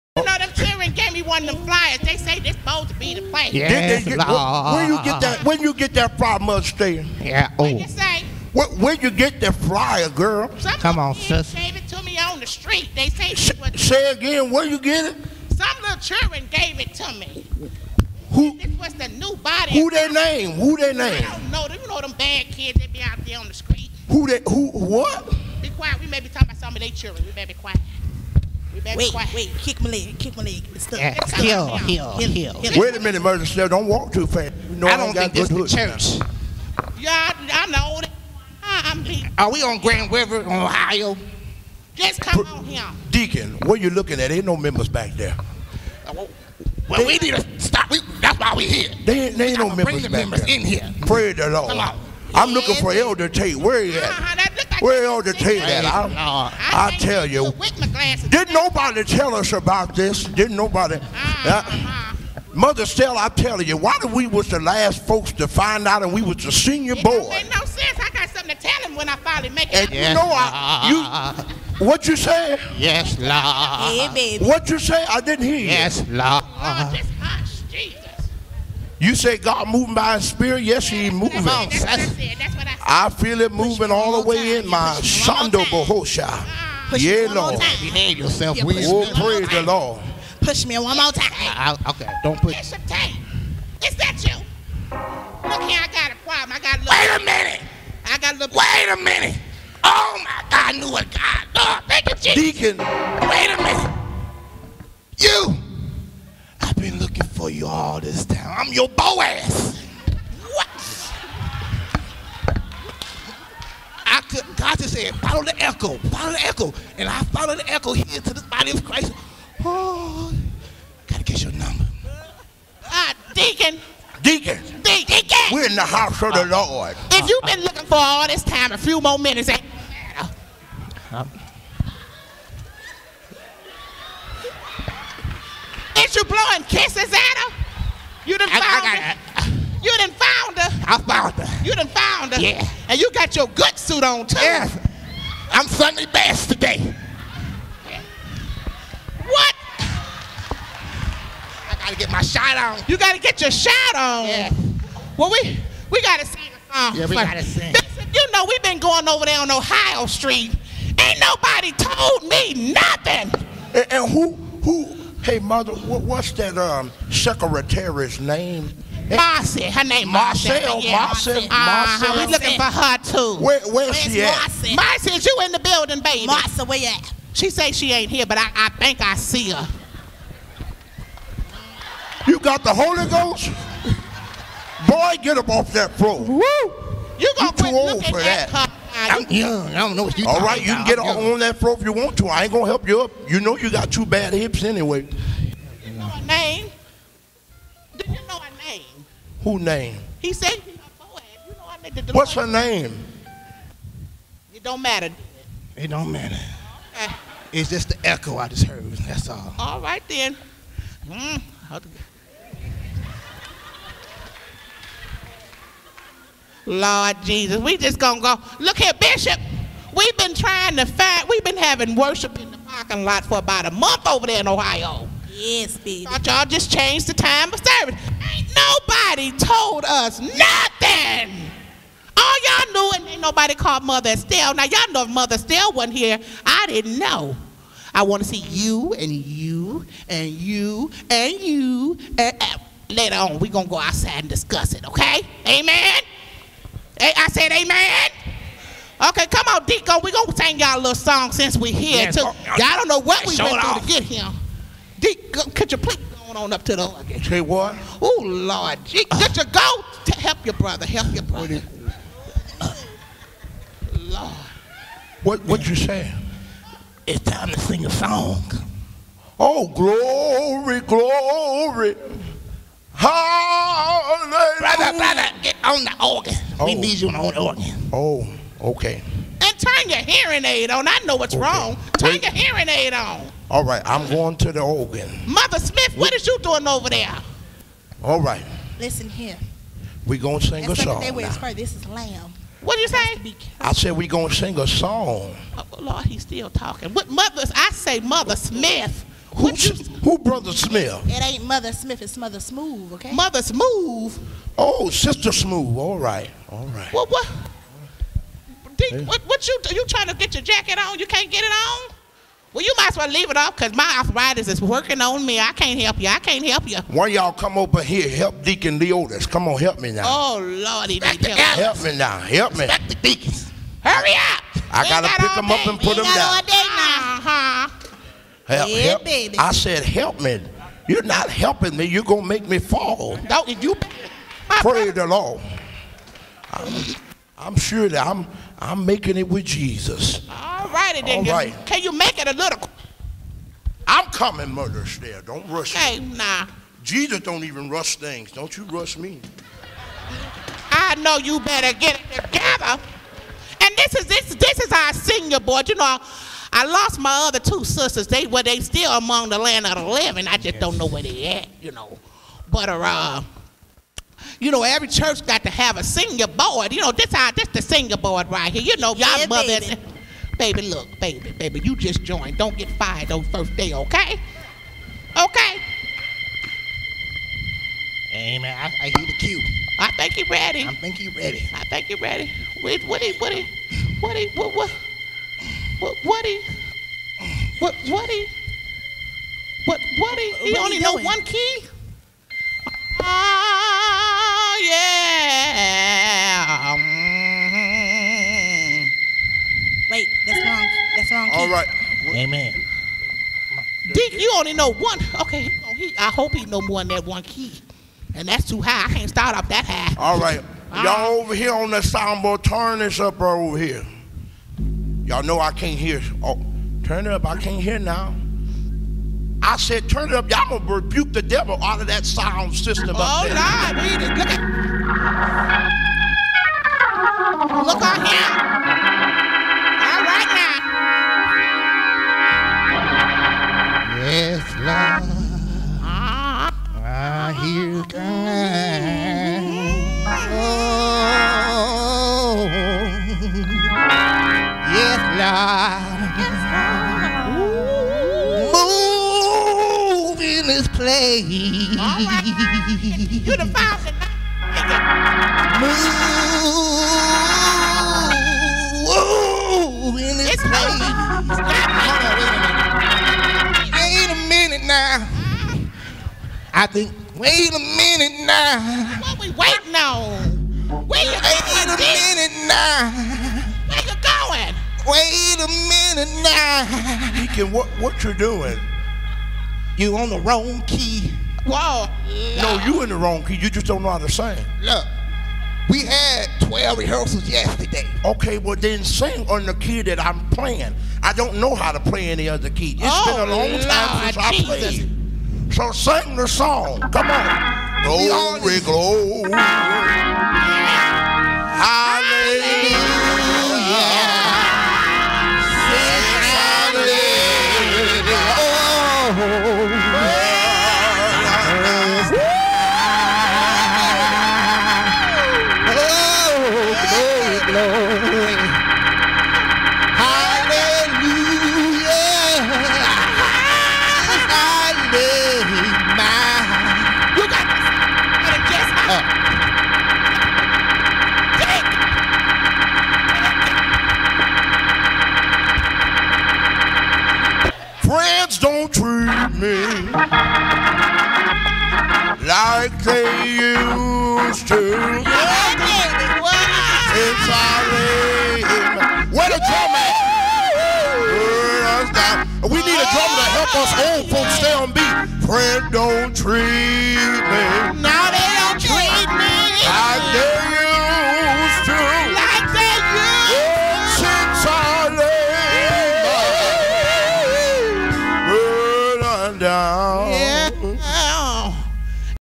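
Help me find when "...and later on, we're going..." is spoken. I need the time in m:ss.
4:02.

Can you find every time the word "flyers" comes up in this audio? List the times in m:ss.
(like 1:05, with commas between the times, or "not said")
0:01, 0:09.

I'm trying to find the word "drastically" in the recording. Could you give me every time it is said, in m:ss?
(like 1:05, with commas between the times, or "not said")
not said.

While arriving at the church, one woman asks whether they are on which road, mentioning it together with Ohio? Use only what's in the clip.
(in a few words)
Grand River.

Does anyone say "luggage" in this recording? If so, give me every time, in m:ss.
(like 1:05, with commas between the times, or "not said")
4:16.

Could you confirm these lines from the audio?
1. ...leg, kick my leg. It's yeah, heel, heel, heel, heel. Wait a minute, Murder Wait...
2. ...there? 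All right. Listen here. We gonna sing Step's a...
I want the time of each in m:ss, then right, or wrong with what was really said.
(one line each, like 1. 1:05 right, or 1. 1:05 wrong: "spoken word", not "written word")
1. 0:29 wrong: "Step", not "Wait"
2. 4:46 wrong: "That", not "Step".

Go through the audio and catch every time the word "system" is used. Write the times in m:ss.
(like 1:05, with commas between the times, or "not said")
7:02.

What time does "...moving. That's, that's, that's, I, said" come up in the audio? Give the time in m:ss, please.
1:21.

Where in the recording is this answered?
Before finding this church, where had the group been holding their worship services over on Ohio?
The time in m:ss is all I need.
3:42.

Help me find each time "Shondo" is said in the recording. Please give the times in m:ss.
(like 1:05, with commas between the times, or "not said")
1:25.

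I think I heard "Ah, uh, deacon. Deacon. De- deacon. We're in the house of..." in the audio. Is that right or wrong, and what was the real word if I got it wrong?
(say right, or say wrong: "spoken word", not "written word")
right.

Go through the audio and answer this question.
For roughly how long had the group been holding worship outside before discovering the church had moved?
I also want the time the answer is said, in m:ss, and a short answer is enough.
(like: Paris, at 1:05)
About a month, at 3:43.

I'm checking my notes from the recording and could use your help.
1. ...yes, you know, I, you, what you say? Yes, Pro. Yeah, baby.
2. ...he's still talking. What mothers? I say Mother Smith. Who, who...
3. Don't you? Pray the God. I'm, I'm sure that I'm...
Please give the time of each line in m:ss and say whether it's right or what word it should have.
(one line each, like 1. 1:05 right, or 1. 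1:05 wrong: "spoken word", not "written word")
1. 1:09 wrong: "Lord", not "Pro"
2. 4:56 right
3. 5:33 wrong: "Lord", not "God".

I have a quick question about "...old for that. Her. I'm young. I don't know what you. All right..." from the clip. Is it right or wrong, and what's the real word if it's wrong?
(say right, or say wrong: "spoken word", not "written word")
right.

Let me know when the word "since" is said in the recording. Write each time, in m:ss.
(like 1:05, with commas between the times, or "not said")
4:11, 8:14.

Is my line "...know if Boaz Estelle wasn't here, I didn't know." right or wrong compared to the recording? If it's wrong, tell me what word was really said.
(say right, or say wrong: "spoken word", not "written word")
wrong: "Mother", not "Boaz".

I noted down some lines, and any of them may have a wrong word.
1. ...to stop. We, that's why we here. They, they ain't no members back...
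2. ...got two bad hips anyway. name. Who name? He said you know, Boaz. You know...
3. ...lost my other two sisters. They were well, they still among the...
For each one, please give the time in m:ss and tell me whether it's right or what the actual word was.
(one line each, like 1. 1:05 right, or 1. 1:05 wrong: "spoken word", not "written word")
1. 0:47 right
2. 3:13 right
3. 5:56 right.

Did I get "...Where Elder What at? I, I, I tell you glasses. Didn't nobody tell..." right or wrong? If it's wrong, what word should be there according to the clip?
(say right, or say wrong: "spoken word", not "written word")
wrong: "Tate", not "What".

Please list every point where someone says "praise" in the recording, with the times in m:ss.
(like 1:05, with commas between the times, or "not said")
0:51, 1:29.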